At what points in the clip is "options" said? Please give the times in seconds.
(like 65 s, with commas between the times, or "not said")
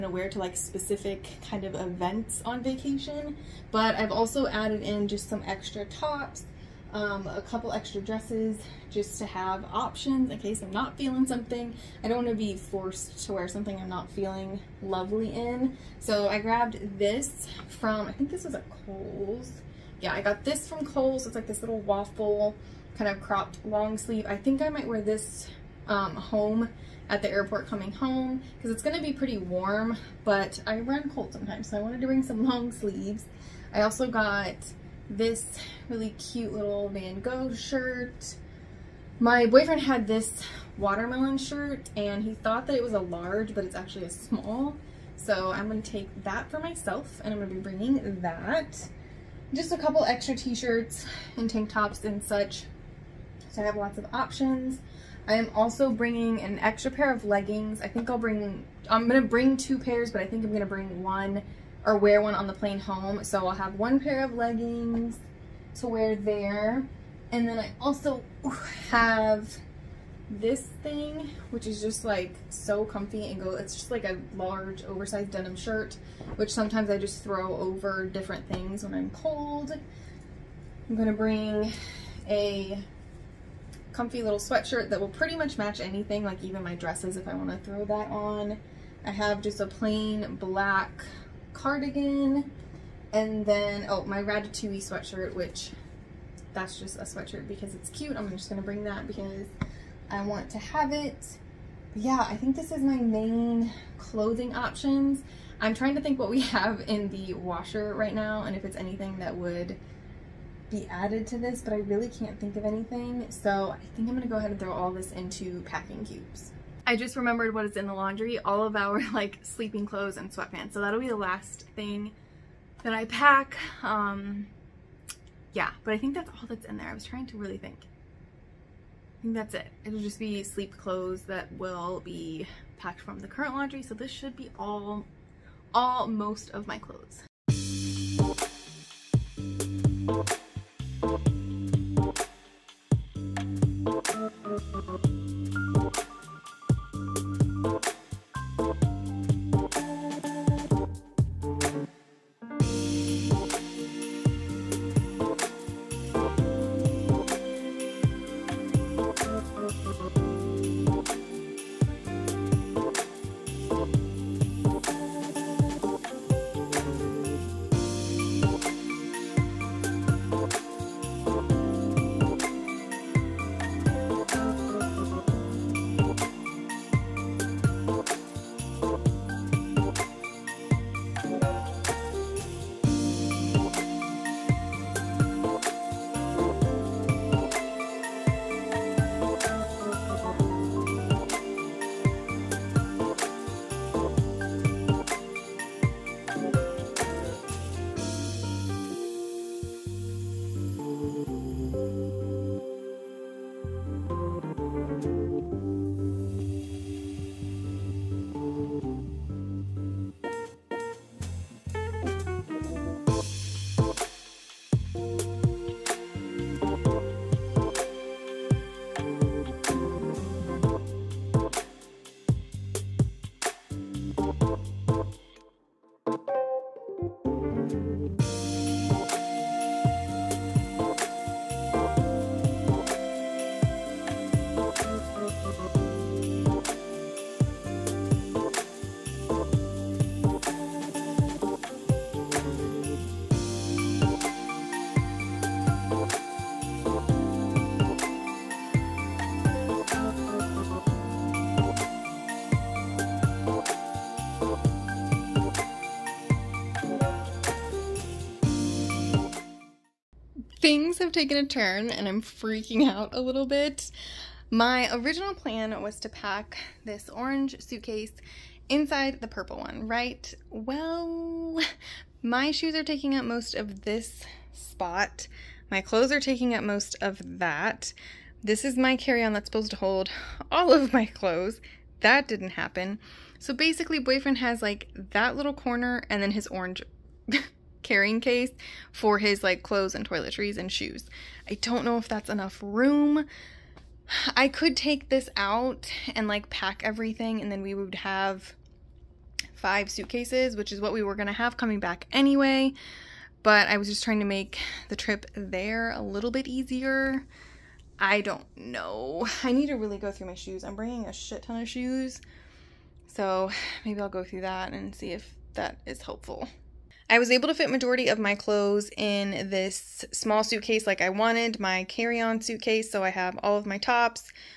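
9 s, 54 s, 104 s.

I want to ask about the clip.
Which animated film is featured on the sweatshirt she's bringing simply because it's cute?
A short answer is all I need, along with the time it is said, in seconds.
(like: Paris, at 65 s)
Ratatouille, at 94 s.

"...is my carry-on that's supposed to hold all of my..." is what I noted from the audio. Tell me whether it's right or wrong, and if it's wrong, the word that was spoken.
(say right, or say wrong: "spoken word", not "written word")
right.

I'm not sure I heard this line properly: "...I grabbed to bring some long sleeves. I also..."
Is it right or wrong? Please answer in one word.
wrong.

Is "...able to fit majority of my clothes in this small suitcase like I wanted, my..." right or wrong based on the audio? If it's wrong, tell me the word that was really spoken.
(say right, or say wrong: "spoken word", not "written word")
right.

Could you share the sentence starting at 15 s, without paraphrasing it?
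So I grabbed this from, I think this was at Kohl's.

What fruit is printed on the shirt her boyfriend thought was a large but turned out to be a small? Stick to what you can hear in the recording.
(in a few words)
Watermelon.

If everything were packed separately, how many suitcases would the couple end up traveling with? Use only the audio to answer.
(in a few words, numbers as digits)
5.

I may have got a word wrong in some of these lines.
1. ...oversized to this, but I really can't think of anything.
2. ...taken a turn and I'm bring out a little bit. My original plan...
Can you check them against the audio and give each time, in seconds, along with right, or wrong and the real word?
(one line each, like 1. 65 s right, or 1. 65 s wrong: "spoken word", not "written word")
1. 110 s wrong: "added", not "oversized"
2. 261 s wrong: "freaking", not "bring".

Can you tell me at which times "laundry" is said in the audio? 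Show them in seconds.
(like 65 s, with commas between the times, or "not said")
117 s, 133 s.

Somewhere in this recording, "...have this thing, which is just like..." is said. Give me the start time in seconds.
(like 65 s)
68 s.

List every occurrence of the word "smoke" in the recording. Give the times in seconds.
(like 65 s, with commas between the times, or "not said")
not said.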